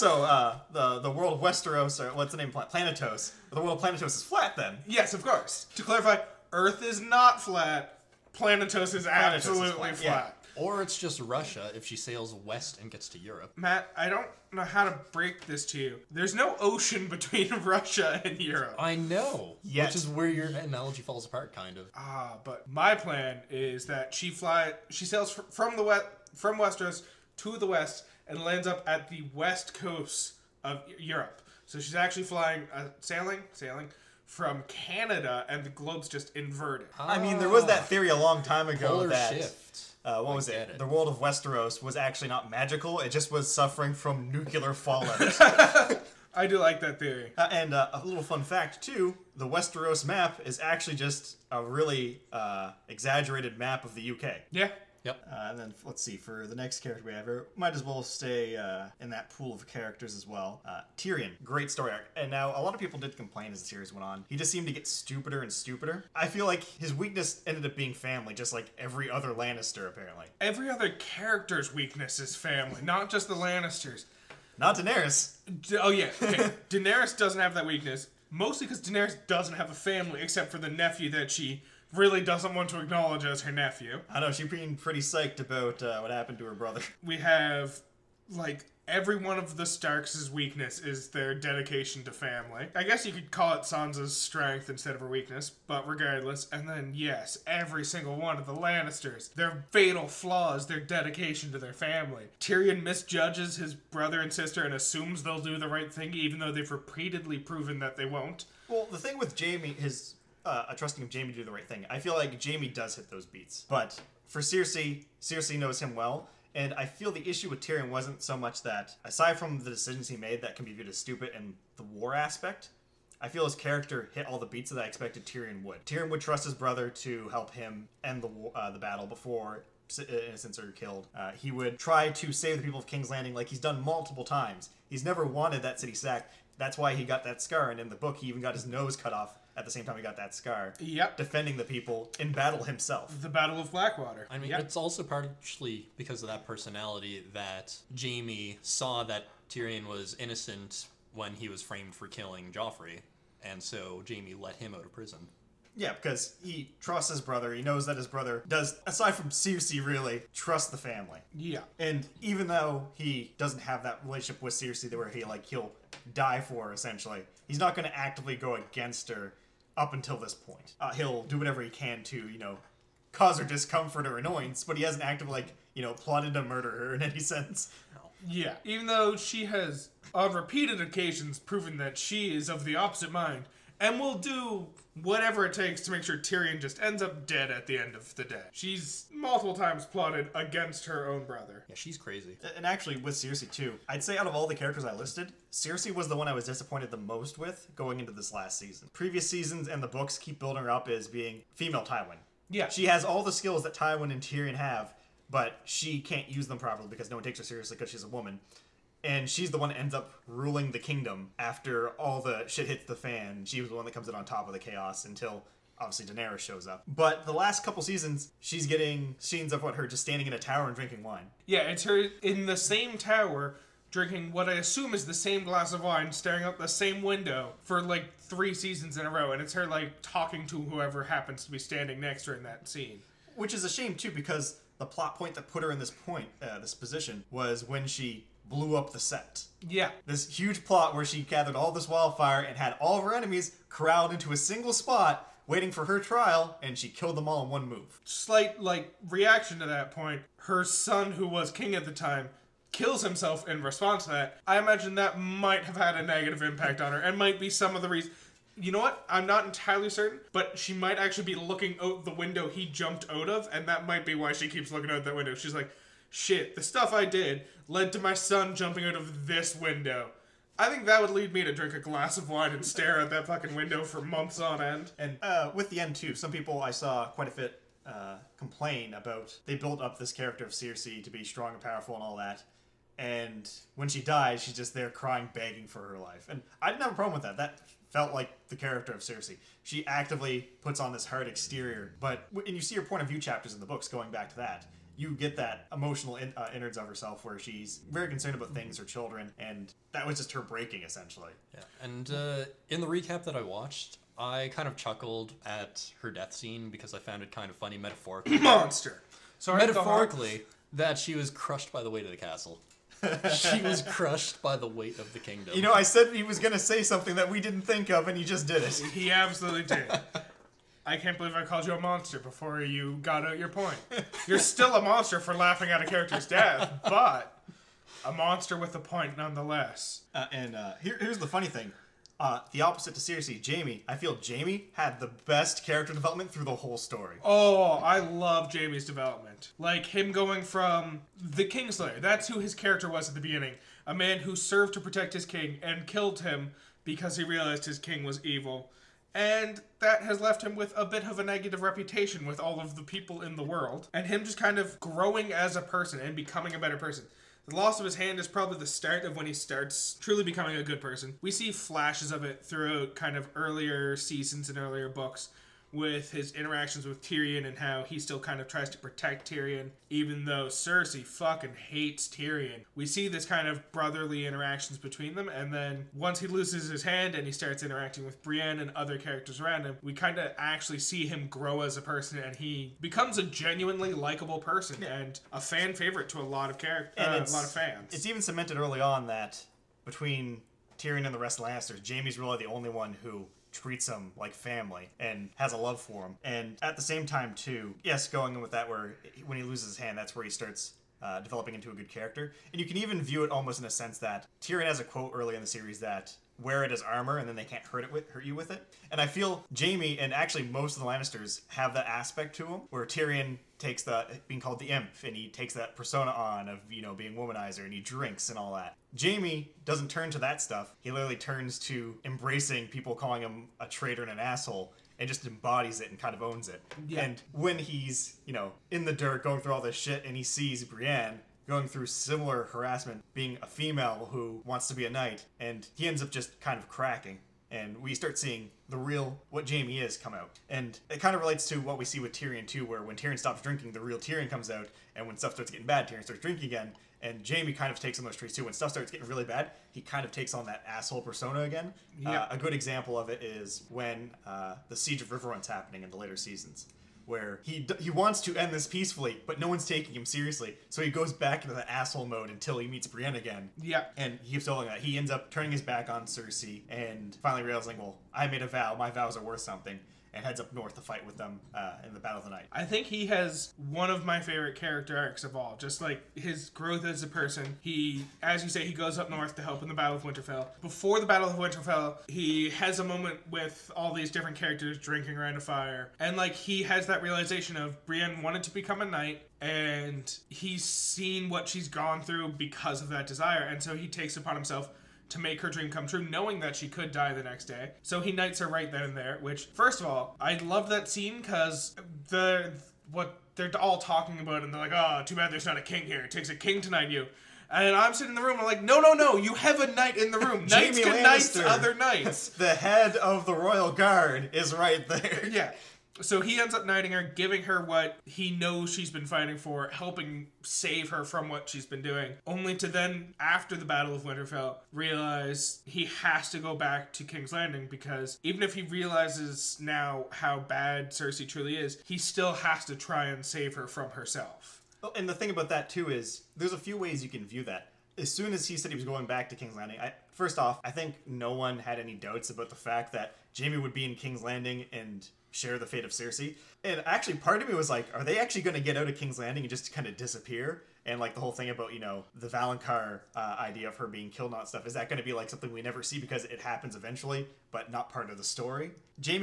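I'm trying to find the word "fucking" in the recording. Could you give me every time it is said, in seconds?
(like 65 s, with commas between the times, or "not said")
273 s, 371 s.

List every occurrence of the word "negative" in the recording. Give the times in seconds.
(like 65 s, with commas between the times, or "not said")
256 s, 351 s.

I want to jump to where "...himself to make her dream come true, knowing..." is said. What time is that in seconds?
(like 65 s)
494 s.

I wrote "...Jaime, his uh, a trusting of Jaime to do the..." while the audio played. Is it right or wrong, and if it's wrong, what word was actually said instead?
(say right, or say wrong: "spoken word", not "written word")
right.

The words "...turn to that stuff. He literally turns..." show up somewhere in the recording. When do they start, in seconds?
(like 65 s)
419 s.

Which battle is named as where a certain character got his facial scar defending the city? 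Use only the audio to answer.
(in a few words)
The Battle of Blackwater.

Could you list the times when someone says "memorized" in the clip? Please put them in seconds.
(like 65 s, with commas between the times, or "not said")
not said.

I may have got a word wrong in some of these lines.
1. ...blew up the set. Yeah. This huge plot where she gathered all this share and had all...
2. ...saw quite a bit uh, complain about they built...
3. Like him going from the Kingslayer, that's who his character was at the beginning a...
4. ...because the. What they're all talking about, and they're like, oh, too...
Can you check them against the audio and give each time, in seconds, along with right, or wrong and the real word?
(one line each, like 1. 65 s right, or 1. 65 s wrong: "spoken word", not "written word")
1. 238 s wrong: "wildfire", not "share"
2. 276 s right
3. 339 s right
4. 501 s right.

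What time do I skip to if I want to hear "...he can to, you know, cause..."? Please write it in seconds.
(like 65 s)
171 s.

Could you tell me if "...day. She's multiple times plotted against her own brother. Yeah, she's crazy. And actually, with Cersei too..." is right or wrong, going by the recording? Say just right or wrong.
right.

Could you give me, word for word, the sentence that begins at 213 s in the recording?
She was the one that comes in on top of the chaos until obviously Daenerys shows up.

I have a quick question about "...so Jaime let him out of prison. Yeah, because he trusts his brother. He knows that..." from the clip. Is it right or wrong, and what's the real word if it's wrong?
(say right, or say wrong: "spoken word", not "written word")
right.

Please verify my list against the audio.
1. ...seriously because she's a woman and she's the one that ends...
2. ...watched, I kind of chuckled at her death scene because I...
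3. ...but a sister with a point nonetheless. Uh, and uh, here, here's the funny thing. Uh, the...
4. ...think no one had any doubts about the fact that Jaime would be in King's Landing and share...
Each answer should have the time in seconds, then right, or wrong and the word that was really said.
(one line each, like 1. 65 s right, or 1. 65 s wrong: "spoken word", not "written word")
1. 207 s right
2. 303 s right
3. 326 s wrong: "monster", not "sister"
4. 540 s right.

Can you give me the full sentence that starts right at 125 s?
Tyrion would trust his brother to help him end the uh, the battle before uh, innocents are killed.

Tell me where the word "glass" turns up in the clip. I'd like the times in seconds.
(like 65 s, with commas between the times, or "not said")
225 s, 271 s.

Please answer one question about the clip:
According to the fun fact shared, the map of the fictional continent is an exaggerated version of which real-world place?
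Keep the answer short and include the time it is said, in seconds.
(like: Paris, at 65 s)
the UK, at 53 s.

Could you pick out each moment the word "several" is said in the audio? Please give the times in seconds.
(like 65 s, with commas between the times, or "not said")
not said.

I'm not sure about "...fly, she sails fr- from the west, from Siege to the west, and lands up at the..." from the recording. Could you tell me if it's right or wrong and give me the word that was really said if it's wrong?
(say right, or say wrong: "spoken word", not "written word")
wrong: "Westeros", not "Siege".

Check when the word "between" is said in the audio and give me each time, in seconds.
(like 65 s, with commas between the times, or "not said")
17 s, 374 s, 389 s.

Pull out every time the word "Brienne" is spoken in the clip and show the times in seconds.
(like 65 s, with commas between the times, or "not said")
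378 s, 430 s, 462 s, 487 s.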